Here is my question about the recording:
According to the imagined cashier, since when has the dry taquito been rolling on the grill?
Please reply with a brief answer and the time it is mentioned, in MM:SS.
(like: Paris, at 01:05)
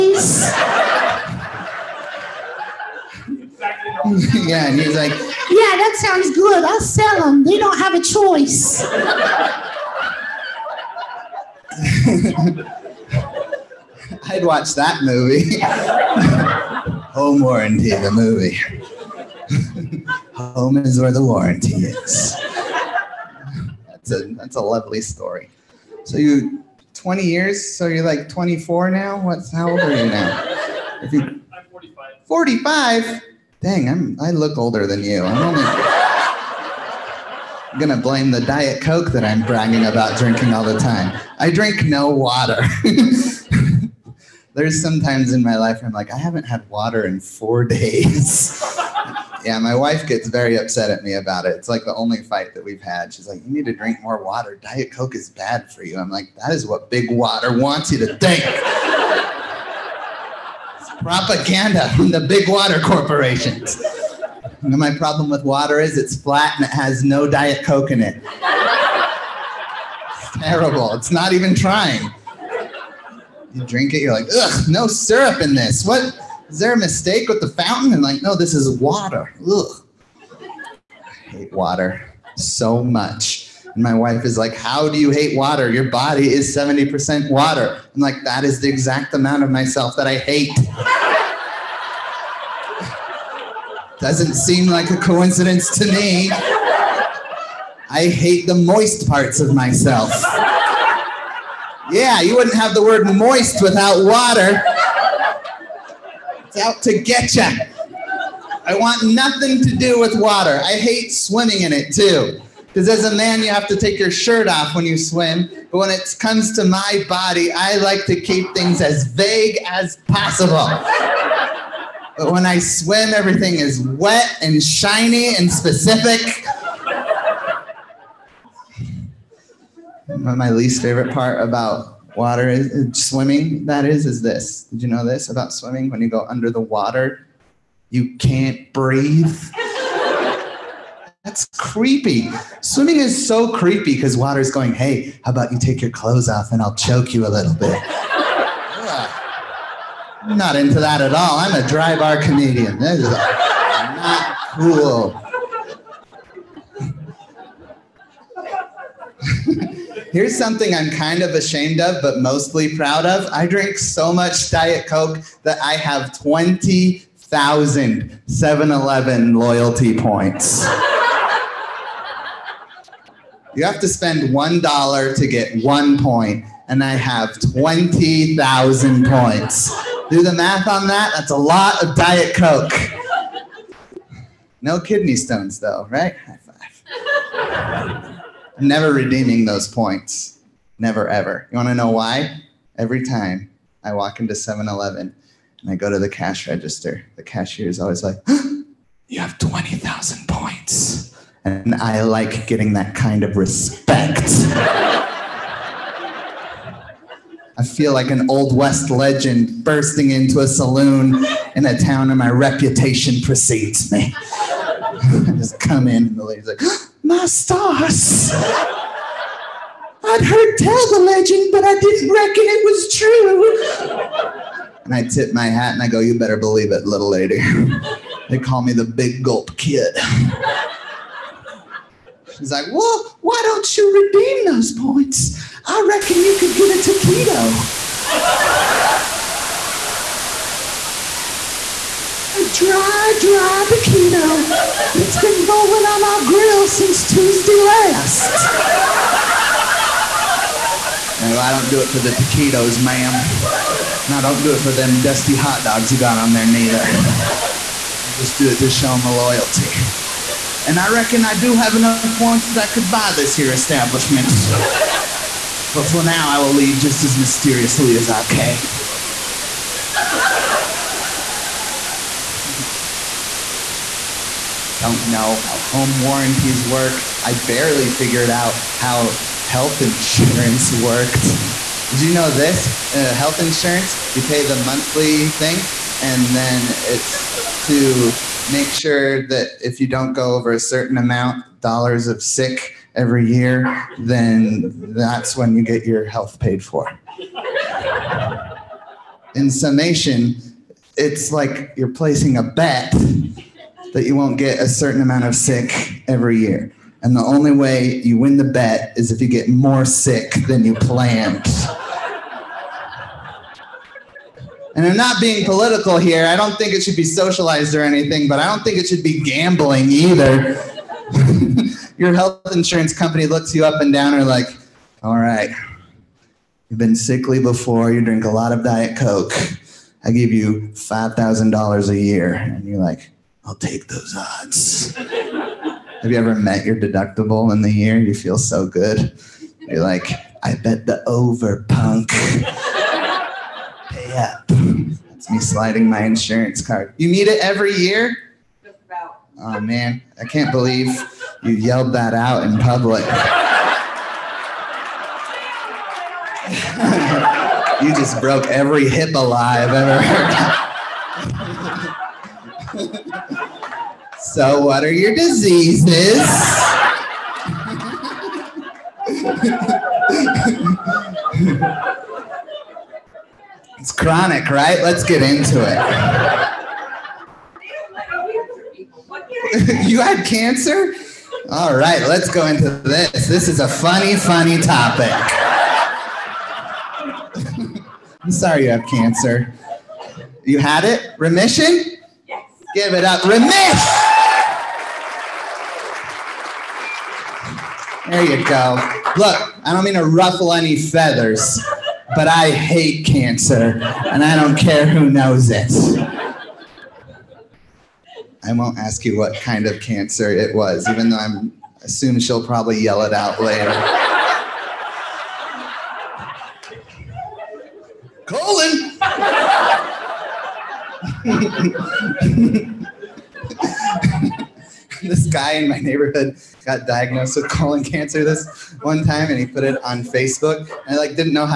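Tuesday last, at 04:07.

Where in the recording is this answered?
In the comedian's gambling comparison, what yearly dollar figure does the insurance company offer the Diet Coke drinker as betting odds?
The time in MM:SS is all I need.
05:30.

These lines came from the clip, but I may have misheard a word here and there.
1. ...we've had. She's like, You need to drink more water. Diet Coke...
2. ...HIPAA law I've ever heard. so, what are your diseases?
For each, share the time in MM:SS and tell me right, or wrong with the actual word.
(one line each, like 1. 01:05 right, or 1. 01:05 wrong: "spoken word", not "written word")
1. 00:52 right
2. 05:58 right.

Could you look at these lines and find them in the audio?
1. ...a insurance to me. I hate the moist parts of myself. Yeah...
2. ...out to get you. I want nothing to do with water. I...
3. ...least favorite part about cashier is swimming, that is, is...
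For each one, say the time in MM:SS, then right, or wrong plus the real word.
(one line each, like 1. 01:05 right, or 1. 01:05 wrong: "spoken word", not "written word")
1. 01:34 wrong: "coincidence", not "insurance"
2. 01:46 right
3. 02:10 wrong: "water", not "cashier".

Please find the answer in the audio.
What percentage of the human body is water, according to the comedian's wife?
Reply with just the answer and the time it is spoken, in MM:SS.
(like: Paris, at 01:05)
70%, at 01:26.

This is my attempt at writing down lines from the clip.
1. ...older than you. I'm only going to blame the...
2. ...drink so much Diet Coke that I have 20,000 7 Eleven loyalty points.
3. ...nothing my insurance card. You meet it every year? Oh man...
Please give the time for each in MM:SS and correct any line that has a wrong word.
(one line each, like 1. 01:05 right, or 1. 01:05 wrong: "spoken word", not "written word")
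1. 00:34 right
2. 02:43 right
3. 05:45 wrong: "sliding", not "nothing".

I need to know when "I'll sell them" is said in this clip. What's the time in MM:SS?
00:06.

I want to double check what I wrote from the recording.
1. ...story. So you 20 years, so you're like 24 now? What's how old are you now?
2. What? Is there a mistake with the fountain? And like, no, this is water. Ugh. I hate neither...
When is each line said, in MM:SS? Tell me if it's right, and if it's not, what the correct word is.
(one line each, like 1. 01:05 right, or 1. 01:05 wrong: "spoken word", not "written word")
1. 00:25 right
2. 01:15 wrong: "water", not "neither".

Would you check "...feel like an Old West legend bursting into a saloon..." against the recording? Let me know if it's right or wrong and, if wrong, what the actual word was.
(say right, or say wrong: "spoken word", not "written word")
right.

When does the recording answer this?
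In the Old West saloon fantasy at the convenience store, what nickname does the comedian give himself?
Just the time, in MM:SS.
03:48.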